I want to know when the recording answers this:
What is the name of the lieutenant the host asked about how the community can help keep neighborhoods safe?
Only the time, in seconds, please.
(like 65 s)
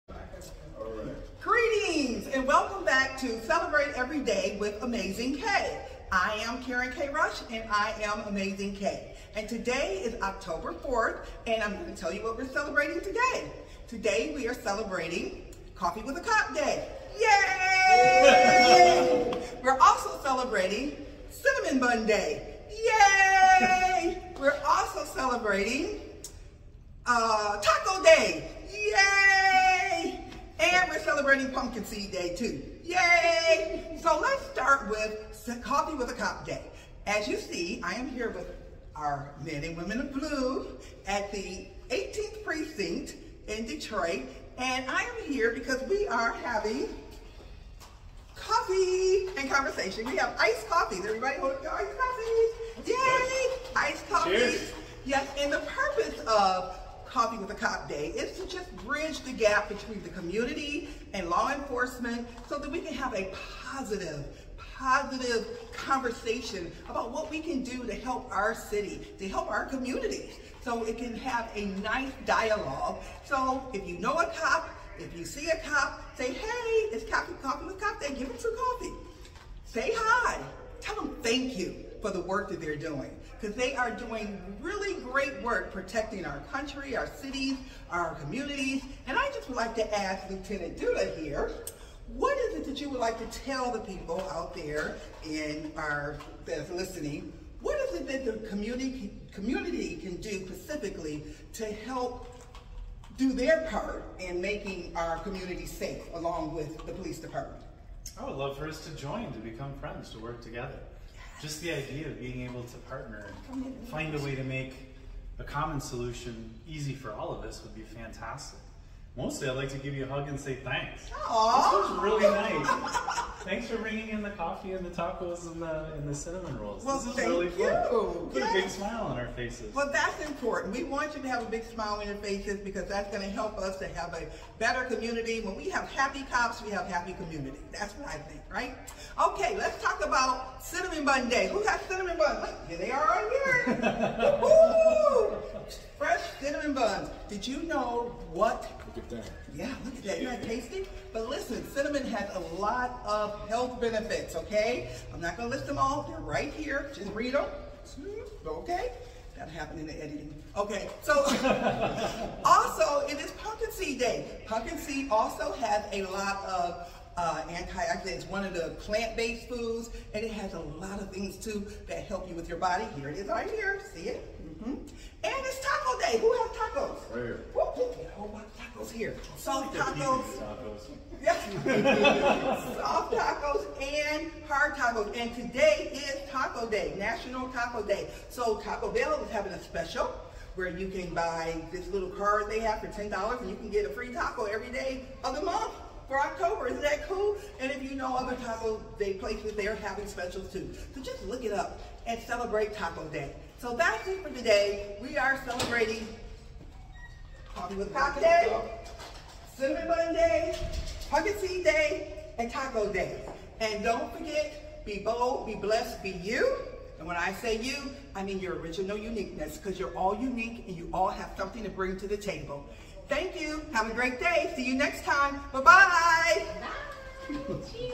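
90 s.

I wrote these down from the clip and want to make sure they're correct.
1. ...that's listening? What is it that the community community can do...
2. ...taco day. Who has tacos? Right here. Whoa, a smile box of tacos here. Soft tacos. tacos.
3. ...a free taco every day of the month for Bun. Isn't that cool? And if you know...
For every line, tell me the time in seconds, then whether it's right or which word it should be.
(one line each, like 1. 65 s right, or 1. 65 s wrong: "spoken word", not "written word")
1. 96 s right
2. 175 s wrong: "whole", not "smile"
3. 193 s wrong: "October", not "Bun".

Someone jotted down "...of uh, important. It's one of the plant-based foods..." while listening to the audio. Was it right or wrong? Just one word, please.
wrong.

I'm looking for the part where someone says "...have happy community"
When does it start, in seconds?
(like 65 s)
136 s.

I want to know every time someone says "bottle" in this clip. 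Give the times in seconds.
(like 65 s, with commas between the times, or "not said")
not said.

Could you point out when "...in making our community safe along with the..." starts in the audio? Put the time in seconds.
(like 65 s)
104 s.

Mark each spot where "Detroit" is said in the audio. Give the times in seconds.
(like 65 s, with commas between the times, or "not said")
43 s.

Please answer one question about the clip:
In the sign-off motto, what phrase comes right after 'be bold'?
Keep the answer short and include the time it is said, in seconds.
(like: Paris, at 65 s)
be blessed, at 215 s.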